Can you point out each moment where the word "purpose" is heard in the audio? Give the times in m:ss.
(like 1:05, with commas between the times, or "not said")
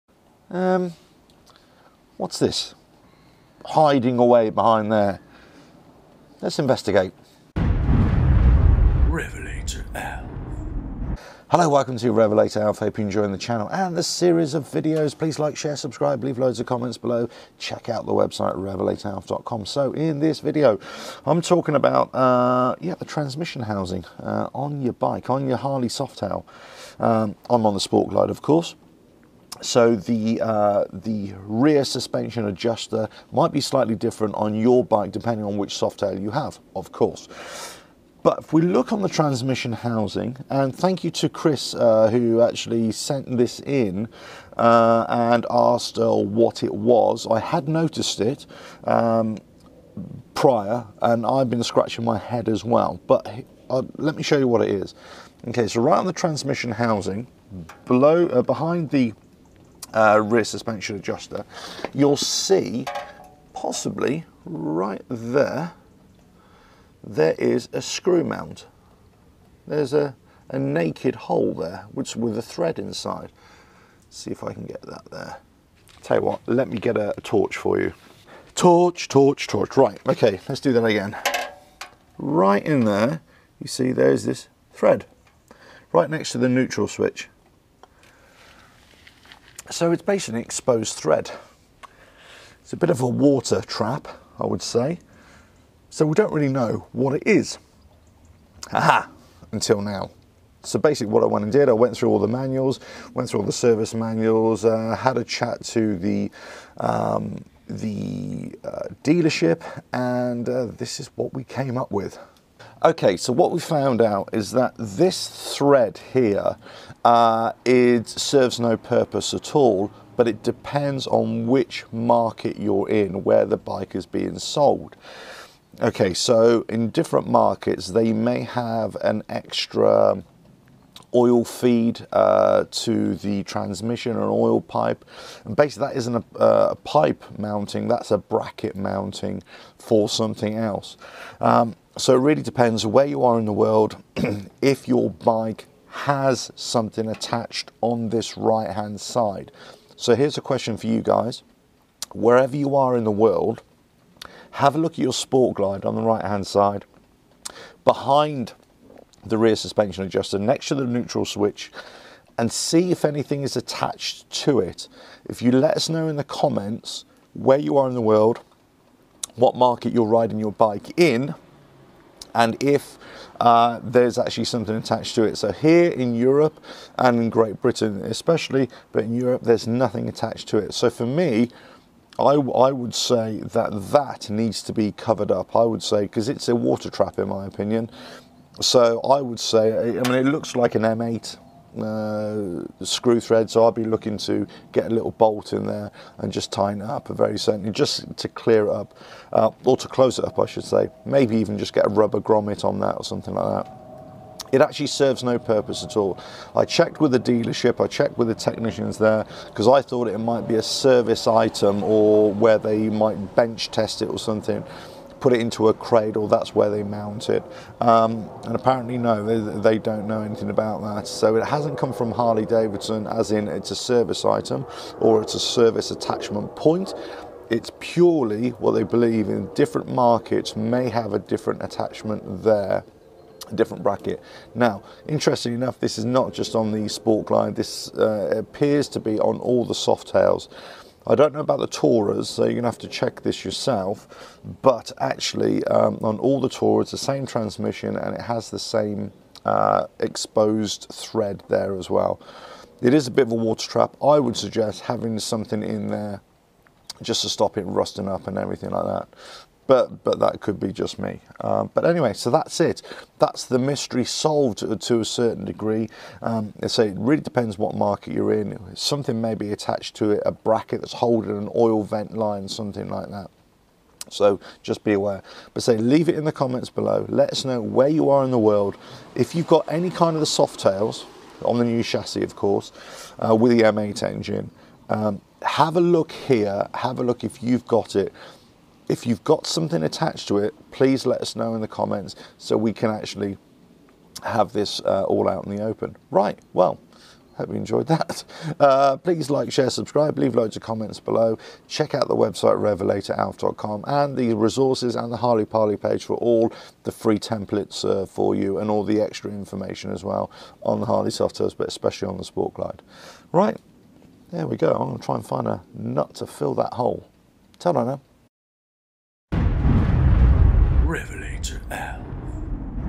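1:58, 3:25.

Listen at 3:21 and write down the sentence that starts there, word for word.
Maybe even just get a rubber grommet on that or something like that.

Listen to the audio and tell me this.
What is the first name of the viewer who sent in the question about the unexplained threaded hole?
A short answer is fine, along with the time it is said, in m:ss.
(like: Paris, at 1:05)
Chris, at 0:41.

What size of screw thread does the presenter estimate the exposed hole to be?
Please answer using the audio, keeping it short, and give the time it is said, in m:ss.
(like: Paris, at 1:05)
M8, at 3:10.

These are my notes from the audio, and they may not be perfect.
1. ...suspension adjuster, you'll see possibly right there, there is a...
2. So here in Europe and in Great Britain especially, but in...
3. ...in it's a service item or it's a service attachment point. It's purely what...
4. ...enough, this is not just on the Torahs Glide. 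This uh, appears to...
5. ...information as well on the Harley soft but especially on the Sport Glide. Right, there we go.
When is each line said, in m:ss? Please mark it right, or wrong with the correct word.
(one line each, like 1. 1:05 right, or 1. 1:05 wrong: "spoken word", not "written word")
1. 1:00 right
2. 2:55 right
3. 3:43 right
4. 3:55 wrong: "Sport", not "Torahs"
5. 5:09 right.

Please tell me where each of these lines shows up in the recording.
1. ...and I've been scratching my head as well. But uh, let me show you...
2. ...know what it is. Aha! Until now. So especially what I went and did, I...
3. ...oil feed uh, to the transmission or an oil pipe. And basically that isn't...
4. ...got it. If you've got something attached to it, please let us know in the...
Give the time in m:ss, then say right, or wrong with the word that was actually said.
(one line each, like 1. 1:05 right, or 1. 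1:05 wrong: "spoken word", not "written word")
1. 0:51 right
2. 1:36 wrong: "basically", not "especially"
3. 2:11 right
4. 4:47 right.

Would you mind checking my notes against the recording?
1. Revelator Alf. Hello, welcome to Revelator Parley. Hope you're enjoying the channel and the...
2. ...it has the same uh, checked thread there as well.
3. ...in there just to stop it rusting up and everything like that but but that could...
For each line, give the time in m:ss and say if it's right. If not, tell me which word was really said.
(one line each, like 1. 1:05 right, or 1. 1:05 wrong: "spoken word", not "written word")
1. 0:07 wrong: "Alf", not "Parley"
2. 4:08 wrong: "exposed", not "checked"
3. 4:15 right.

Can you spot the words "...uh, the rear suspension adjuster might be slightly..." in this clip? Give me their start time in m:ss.
0:30.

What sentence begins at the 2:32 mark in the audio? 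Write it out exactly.
Wherever you are in the world, have a look at your sport glide on the right hand side.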